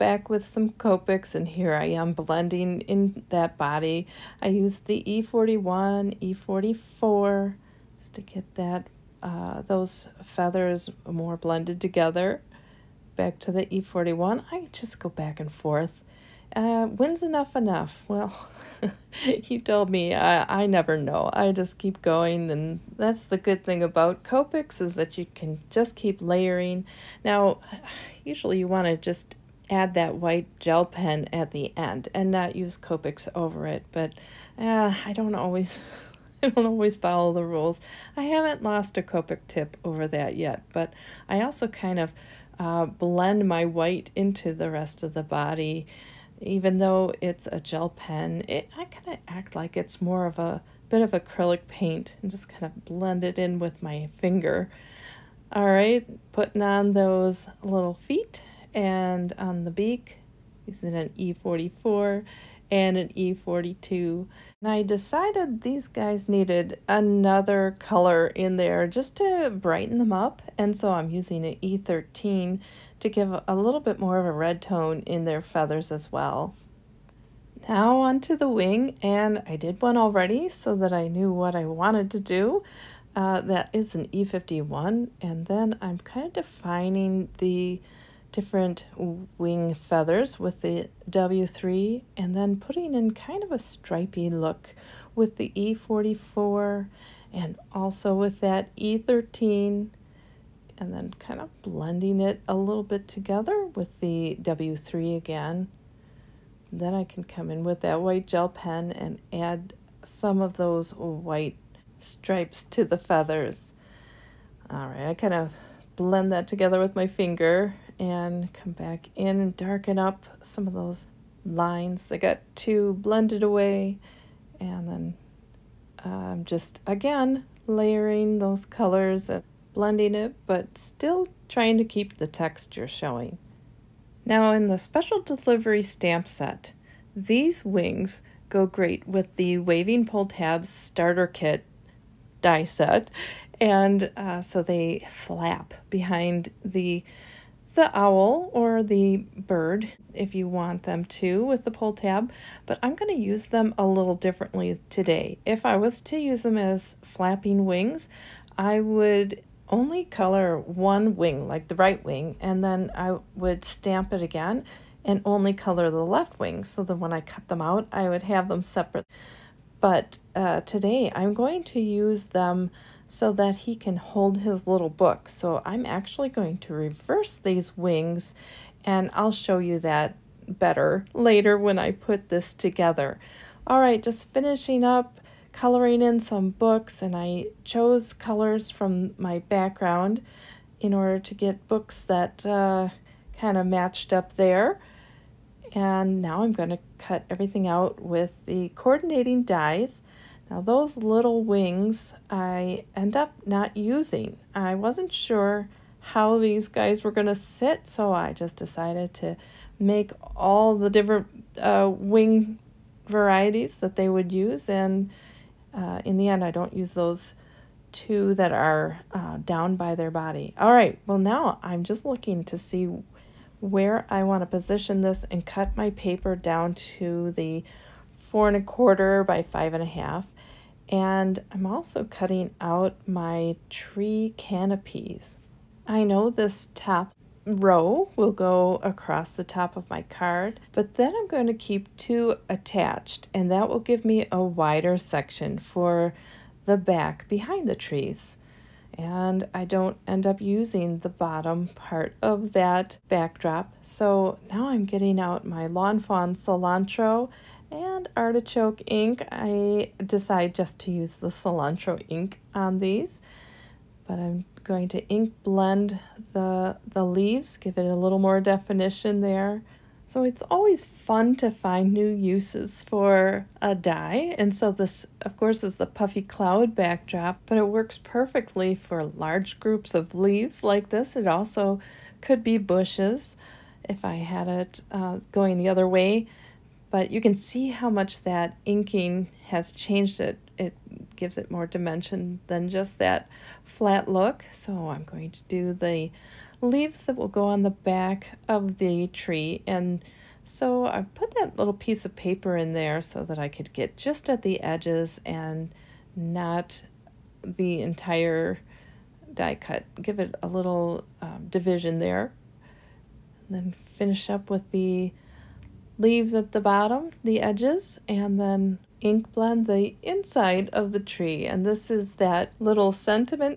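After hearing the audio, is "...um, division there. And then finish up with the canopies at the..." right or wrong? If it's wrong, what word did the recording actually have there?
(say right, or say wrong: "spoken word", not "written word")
wrong: "leaves", not "canopies".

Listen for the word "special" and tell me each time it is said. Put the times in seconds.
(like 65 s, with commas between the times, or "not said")
134 s.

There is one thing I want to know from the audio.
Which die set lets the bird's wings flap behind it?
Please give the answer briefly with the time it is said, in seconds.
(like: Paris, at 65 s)
Waving Pull Tabs Starter Kit, at 139 s.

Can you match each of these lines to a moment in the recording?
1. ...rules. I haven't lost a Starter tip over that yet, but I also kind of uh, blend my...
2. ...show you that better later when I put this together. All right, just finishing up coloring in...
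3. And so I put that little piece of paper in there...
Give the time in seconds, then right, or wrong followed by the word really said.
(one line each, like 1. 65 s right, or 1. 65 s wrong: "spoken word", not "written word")
1. 37 s wrong: "Copic", not "Starter"
2. 179 s right
3. 299 s right.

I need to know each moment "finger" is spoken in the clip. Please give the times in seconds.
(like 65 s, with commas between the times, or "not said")
54 s, 117 s.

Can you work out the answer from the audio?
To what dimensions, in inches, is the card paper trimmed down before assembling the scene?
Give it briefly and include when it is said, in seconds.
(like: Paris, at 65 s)
4 1/4 by 5 1/2, at 228 s.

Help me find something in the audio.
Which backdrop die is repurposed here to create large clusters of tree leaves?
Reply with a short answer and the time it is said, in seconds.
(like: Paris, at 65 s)
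Puffy cloud backdrop, at 275 s.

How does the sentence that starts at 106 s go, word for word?
Then I can come in with that white gel pen and add some of those white stripes to the feathers.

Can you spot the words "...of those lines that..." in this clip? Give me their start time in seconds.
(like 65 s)
120 s.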